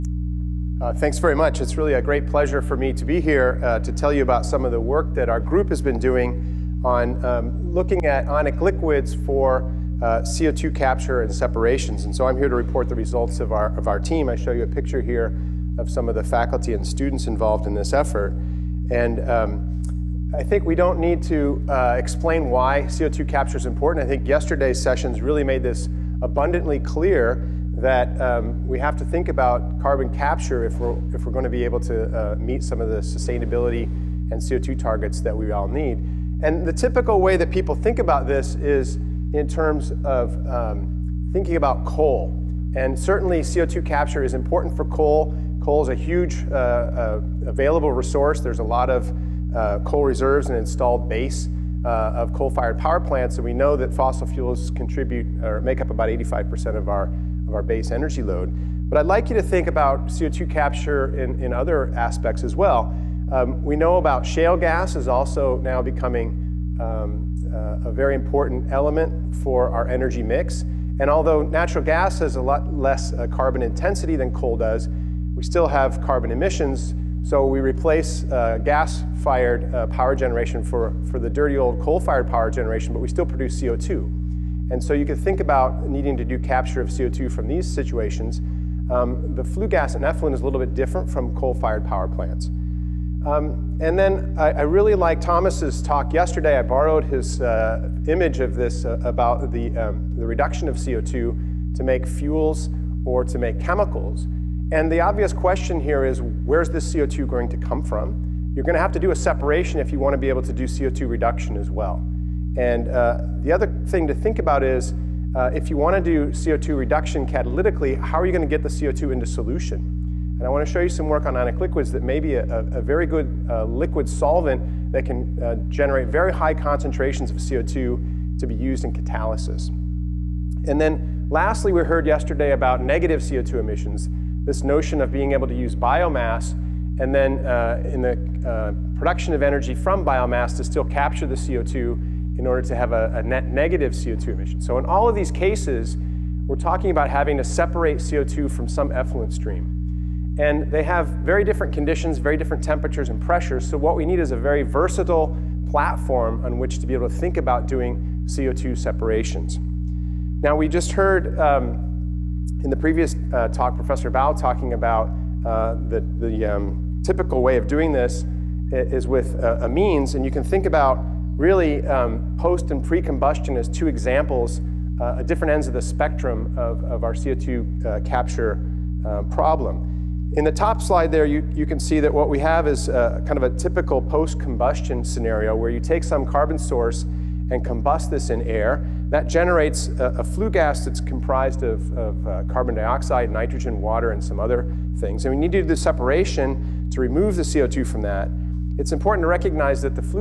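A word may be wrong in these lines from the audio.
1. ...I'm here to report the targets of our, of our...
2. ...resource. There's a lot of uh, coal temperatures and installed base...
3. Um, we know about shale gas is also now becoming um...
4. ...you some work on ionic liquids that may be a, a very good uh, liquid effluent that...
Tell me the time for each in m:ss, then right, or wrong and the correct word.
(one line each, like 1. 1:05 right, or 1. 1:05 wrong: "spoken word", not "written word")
1. 0:12 wrong: "results", not "targets"
2. 0:47 wrong: "reserves", not "temperatures"
3. 1:03 right
4. 2:00 wrong: "solvent", not "effluent".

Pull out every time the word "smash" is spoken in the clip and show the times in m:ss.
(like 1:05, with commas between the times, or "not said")
not said.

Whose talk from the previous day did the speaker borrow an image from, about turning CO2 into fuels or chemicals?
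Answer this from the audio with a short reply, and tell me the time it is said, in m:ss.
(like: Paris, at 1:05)
Thomas, at 1:35.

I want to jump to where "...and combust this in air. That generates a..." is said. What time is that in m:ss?
3:07.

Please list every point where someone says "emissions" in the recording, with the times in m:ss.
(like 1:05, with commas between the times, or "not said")
1:16, 2:13, 2:24.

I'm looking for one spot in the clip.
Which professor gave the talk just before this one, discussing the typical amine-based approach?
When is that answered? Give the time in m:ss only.
2:43.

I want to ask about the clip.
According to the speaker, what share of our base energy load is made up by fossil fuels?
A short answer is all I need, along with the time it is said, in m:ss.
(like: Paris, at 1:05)
85%, at 0:56.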